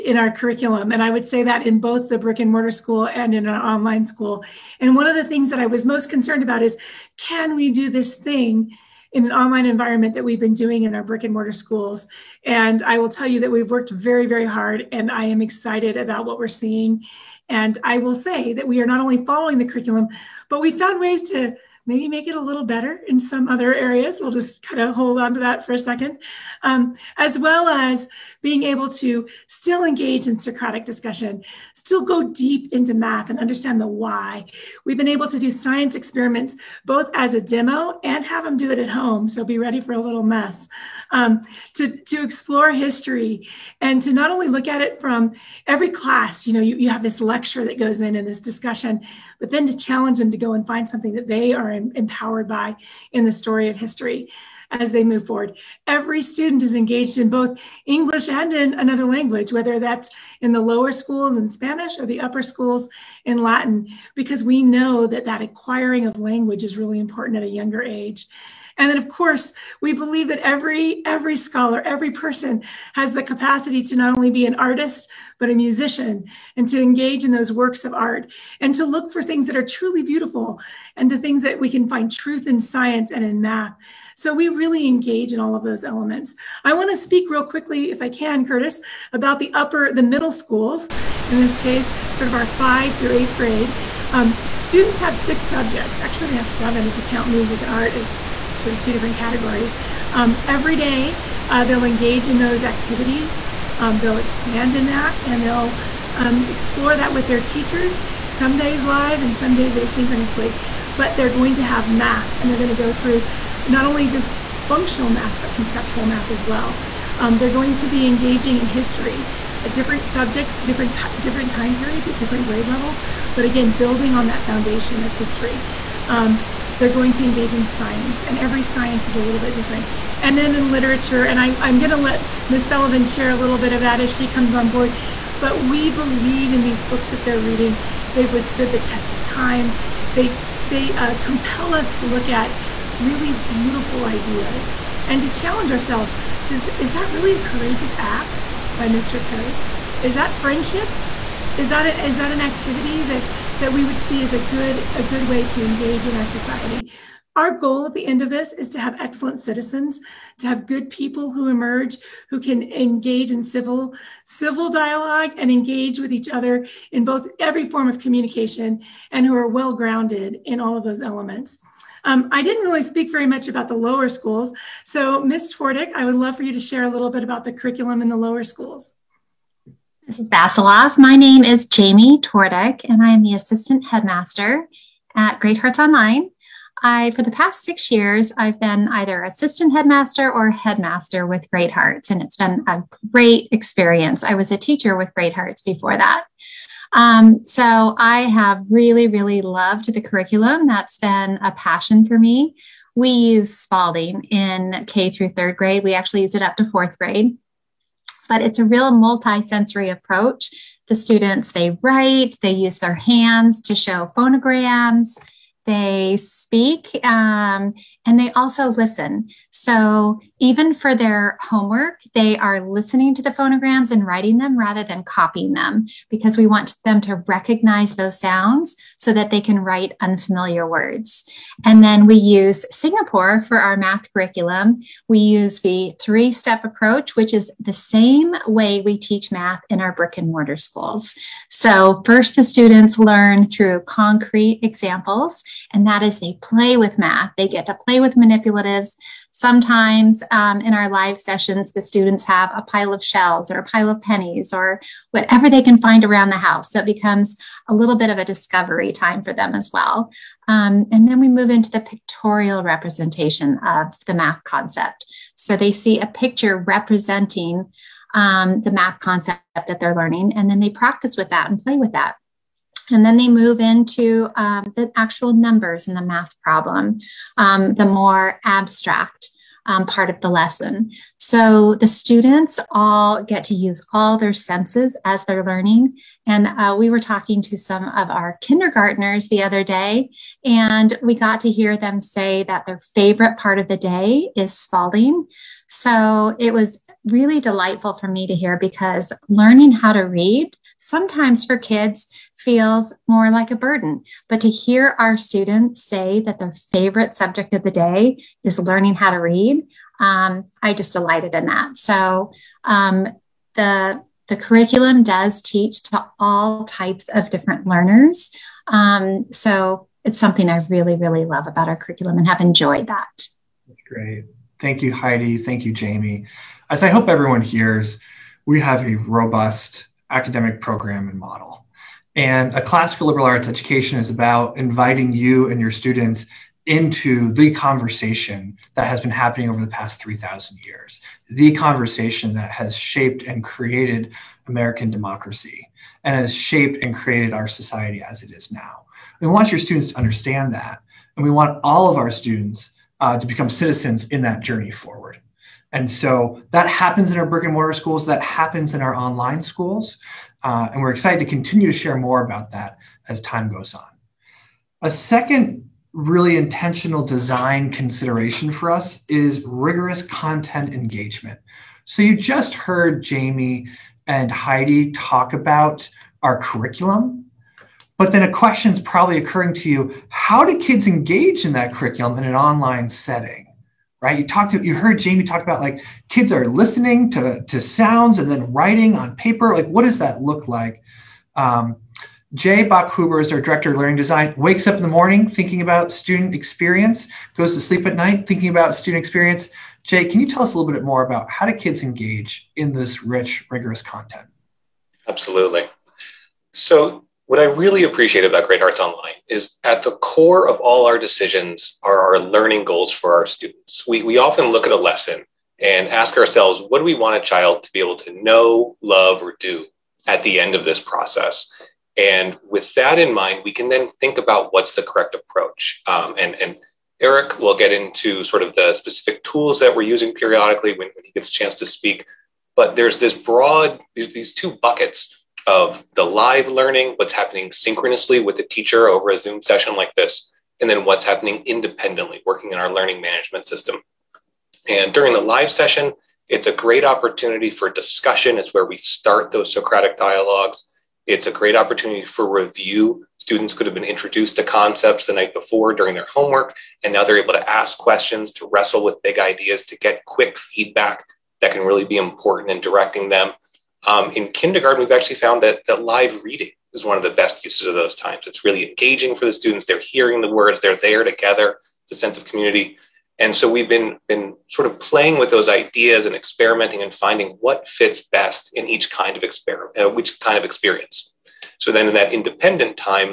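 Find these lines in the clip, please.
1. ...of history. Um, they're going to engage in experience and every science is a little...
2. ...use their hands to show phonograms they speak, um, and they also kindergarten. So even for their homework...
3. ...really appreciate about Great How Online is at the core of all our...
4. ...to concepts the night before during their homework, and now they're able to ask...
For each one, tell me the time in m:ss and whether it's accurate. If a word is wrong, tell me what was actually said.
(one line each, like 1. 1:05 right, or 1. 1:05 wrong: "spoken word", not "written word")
1. 2:05 wrong: "science", not "experience"
2. 3:32 wrong: "listen", not "kindergarten"
3. 6:47 wrong: "Hearts", not "How"
4. 7:34 right.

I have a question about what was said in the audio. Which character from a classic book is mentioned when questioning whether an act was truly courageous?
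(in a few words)
Mr. Toad.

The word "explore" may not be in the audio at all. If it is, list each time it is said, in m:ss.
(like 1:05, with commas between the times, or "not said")
0:42, 1:46.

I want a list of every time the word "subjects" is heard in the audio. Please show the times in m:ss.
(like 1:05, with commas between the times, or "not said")
1:35, 2:00, 5:07.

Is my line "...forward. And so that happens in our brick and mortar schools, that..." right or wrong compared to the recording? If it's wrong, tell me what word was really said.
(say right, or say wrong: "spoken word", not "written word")
right.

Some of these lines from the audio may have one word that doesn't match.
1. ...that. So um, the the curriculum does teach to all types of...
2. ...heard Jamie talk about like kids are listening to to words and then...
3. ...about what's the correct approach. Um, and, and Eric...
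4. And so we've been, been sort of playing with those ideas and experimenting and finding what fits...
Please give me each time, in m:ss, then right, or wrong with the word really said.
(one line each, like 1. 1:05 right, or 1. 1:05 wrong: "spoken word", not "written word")
1. 5:11 right
2. 6:24 wrong: "sounds", not "words"
3. 7:04 right
4. 7:53 right.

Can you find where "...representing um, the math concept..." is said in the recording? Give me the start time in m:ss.
4:26.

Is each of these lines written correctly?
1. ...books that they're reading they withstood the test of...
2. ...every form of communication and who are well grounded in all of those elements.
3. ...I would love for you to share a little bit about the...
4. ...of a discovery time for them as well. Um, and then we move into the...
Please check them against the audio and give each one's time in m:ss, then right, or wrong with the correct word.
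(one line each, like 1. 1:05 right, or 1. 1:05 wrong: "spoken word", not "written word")
1. 2:16 right
2. 2:47 right
3. 2:55 right
4. 4:18 right.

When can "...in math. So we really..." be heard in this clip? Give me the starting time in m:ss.
1:23.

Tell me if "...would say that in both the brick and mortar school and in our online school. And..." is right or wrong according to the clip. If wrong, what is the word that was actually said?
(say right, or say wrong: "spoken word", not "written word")
right.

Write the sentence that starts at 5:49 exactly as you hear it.
We want your students to understand that.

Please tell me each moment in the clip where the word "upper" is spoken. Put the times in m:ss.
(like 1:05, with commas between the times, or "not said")
1:02, 1:29.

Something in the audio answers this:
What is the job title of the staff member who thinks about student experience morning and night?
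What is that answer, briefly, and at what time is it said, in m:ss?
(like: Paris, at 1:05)
director of learning design, at 6:33.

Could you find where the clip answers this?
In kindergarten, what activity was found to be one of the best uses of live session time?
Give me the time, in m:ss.
7:45.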